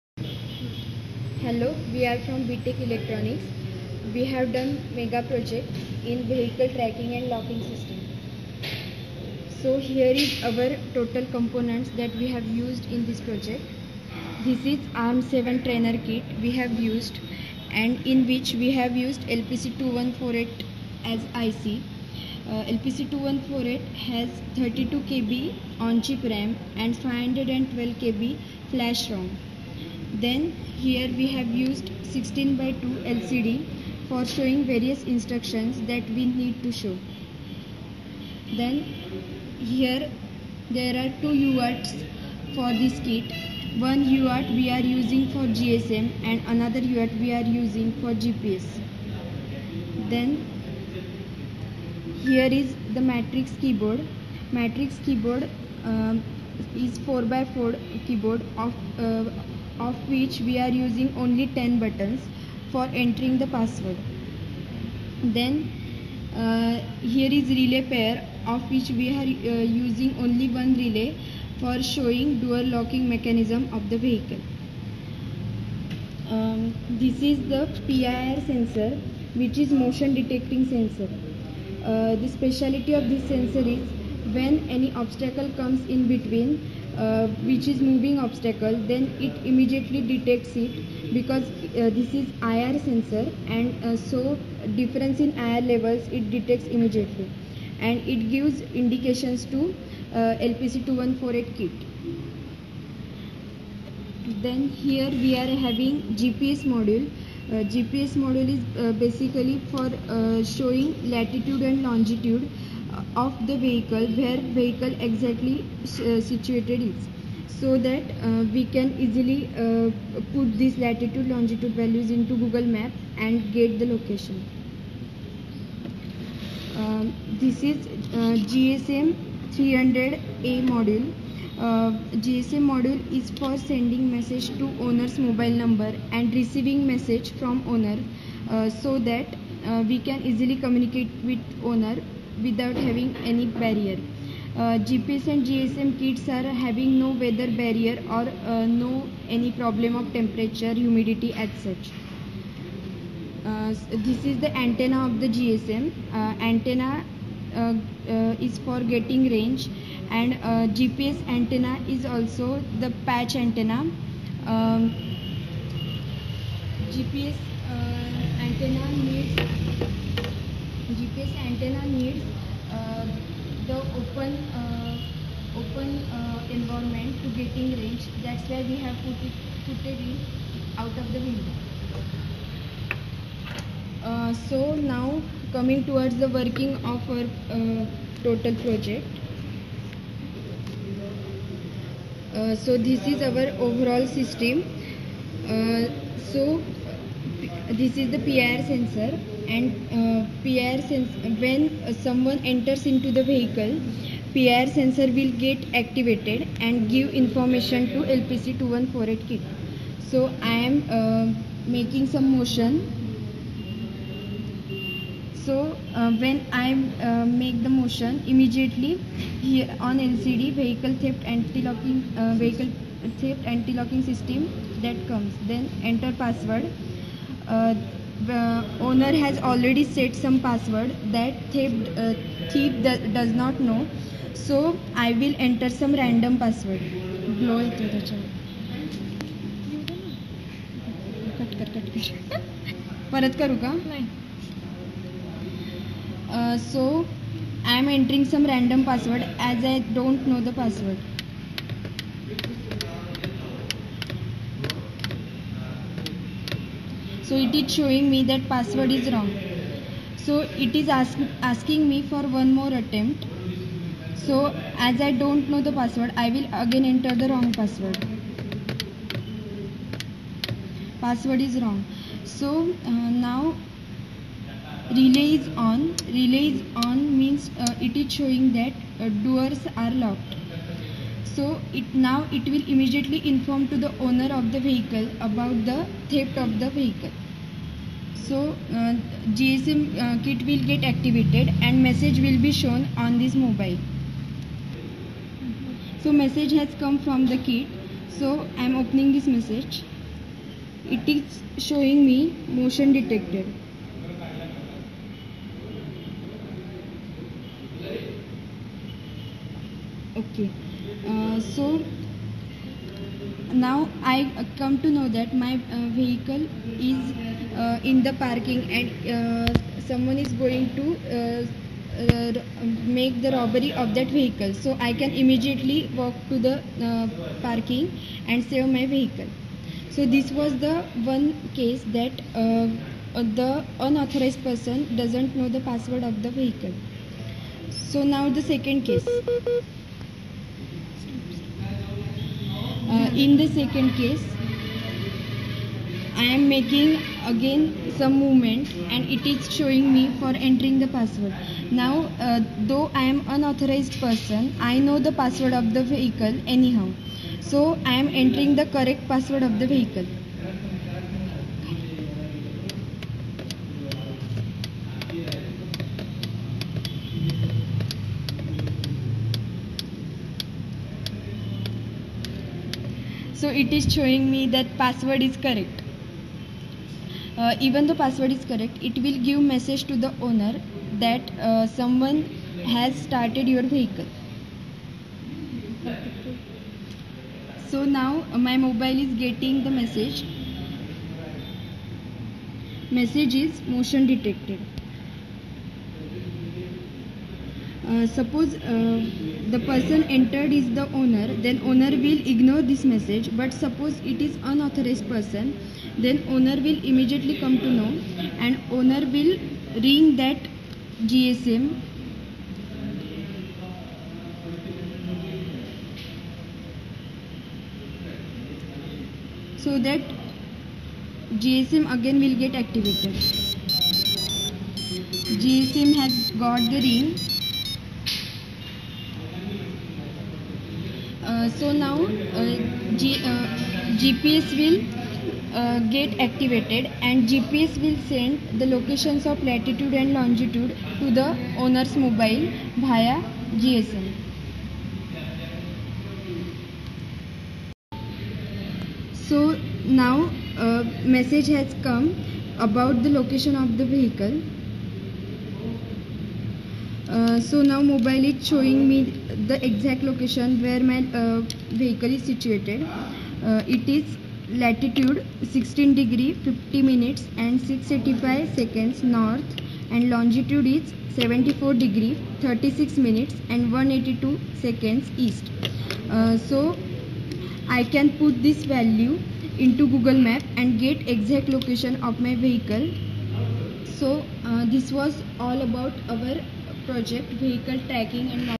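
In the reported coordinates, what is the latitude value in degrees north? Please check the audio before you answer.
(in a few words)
16.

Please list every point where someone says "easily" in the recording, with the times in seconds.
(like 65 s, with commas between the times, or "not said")
119 s, 140 s.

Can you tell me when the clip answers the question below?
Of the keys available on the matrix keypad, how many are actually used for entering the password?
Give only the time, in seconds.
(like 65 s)
61 s.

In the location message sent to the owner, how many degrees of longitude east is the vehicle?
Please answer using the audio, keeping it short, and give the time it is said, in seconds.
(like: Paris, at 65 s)
74, at 471 s.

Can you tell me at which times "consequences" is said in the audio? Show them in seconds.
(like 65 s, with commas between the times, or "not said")
not said.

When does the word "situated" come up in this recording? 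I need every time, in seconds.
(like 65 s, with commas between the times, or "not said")
116 s, 462 s.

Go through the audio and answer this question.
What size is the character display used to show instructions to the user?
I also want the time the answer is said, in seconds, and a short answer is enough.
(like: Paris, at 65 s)
16 by 2, at 32 s.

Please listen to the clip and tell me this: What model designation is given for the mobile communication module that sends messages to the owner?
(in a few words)
300A.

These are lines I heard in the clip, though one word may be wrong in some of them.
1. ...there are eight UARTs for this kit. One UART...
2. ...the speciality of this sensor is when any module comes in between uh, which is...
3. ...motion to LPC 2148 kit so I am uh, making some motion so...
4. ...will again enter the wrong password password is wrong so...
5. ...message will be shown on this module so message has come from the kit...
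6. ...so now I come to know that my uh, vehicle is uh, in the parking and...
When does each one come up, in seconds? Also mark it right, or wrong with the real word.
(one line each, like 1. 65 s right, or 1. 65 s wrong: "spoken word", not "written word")
1. 40 s wrong: "two", not "eight"
2. 82 s wrong: "obstacle", not "module"
3. 207 s wrong: "information", not "motion"
4. 266 s right
5. 291 s wrong: "mobile", not "module"
6. 311 s right.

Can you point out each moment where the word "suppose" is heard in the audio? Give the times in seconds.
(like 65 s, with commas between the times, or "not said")
398 s, 403 s.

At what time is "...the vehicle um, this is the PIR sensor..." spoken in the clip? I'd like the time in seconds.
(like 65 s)
73 s.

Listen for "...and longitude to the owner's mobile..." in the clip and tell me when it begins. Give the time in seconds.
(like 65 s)
439 s.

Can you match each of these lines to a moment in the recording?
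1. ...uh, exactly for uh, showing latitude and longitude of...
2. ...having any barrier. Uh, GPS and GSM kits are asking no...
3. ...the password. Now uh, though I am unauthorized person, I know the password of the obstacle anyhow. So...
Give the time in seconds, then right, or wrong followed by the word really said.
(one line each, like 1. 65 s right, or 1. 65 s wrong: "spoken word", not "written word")
1. 108 s wrong: "basically", not "exactly"
2. 142 s wrong: "having", not "asking"
3. 350 s wrong: "vehicle", not "obstacle".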